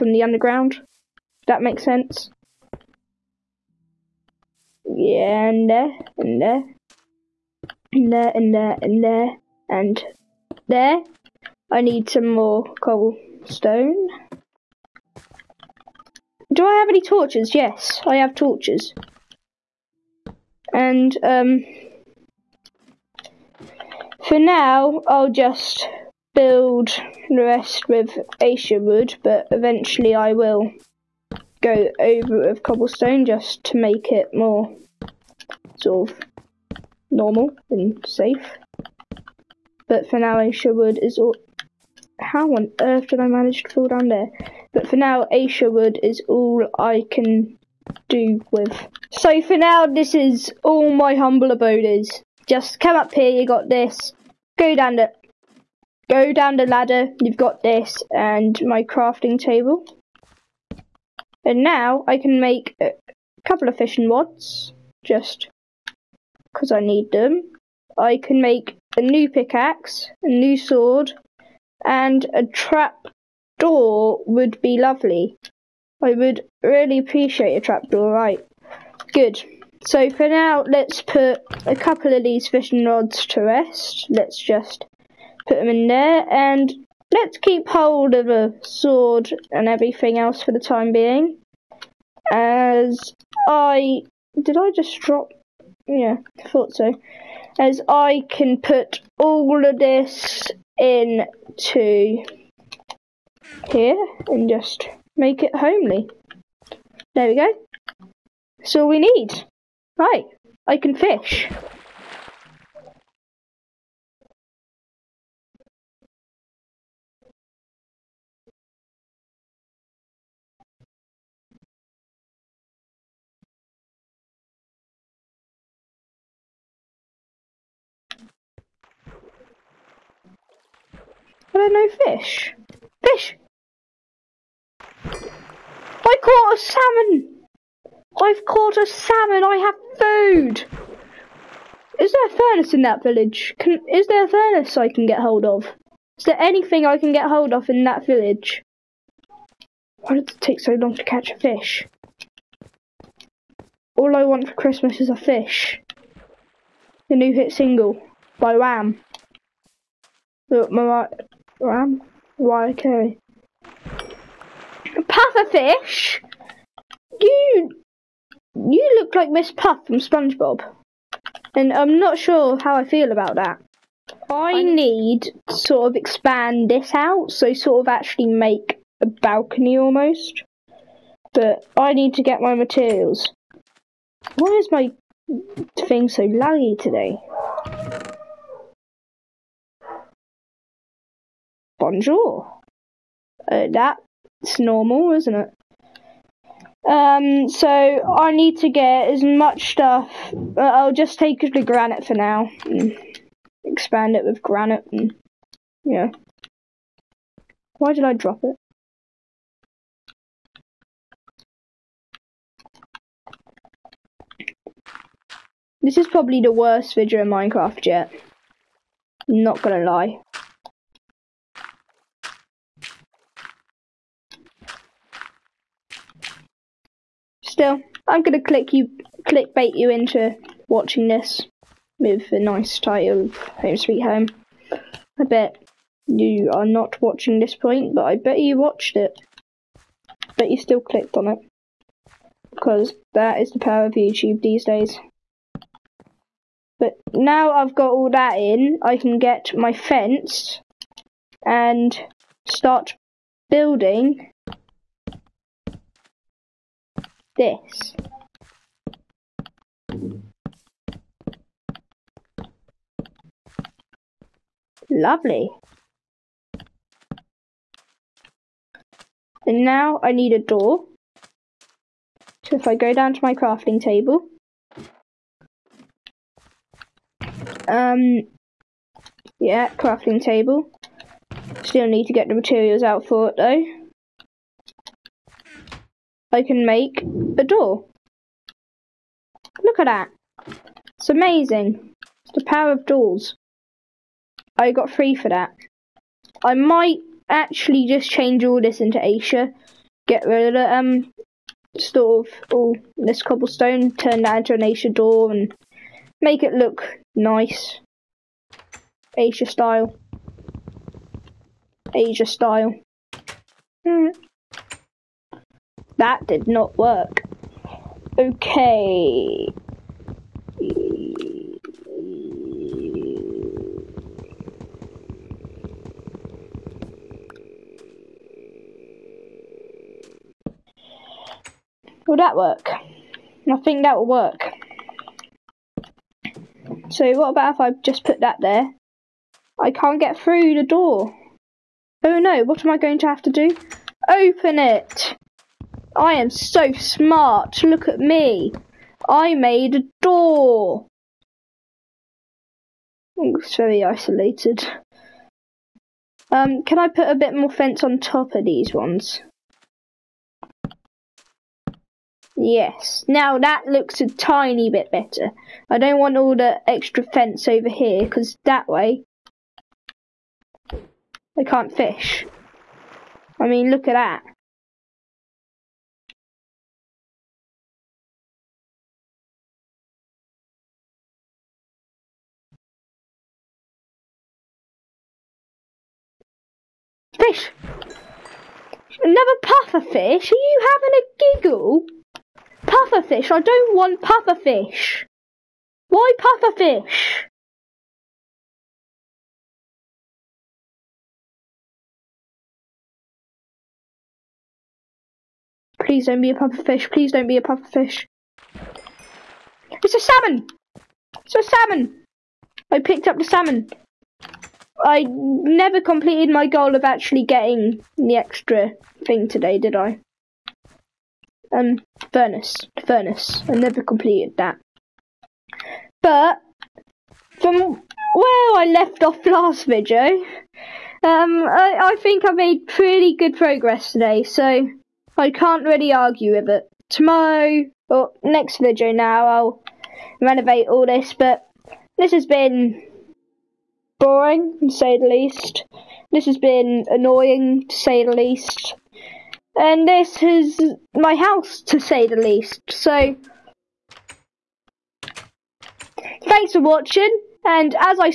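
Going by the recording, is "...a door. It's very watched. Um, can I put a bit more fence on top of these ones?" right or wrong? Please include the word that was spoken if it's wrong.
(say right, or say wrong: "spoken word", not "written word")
wrong: "isolated", not "watched".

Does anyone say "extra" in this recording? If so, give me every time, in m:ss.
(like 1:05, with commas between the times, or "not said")
6:06, 6:58.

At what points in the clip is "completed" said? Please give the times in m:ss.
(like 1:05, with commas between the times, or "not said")
6:55, 7:03.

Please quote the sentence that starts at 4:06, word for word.
But now I've got all that in, I can get my fence and start building this.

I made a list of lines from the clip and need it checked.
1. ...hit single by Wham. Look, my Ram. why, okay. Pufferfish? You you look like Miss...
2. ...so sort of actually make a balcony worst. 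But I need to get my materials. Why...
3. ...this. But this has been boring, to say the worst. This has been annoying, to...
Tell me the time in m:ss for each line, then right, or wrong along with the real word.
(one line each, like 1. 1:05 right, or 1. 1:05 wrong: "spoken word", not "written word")
1. 2:37 right
2. 2:57 wrong: "almost", not "worst"
3. 7:20 wrong: "least", not "worst".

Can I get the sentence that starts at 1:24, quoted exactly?
Let's just put them in there and let's keep hold of a sword and everything else for the time being.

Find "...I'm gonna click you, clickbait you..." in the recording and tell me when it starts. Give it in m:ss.
3:48.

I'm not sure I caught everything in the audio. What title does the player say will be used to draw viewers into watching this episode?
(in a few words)
Home Sweet Home.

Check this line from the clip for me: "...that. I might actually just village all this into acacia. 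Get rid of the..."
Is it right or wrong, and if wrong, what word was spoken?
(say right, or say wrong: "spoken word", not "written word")
wrong: "change", not "village".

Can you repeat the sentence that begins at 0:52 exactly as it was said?
Just come up here, you got this.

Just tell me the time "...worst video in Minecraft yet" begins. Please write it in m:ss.
3:36.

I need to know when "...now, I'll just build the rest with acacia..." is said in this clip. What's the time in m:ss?
0:24.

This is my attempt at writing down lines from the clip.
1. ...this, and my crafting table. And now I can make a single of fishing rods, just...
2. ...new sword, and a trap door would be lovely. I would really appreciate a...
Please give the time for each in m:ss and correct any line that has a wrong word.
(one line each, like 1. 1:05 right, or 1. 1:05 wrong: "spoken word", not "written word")
1. 0:57 wrong: "couple", not "single"
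2. 1:10 right.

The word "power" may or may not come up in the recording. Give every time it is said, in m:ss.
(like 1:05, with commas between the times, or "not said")
4:03, 4:52.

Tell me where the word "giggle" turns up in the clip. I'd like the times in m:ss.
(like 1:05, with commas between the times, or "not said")
6:31.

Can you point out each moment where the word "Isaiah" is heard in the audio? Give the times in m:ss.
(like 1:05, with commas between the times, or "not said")
not said.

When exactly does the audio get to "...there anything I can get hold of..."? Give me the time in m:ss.
2:26.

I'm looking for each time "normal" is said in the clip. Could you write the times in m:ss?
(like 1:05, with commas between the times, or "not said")
0:37, 3:14.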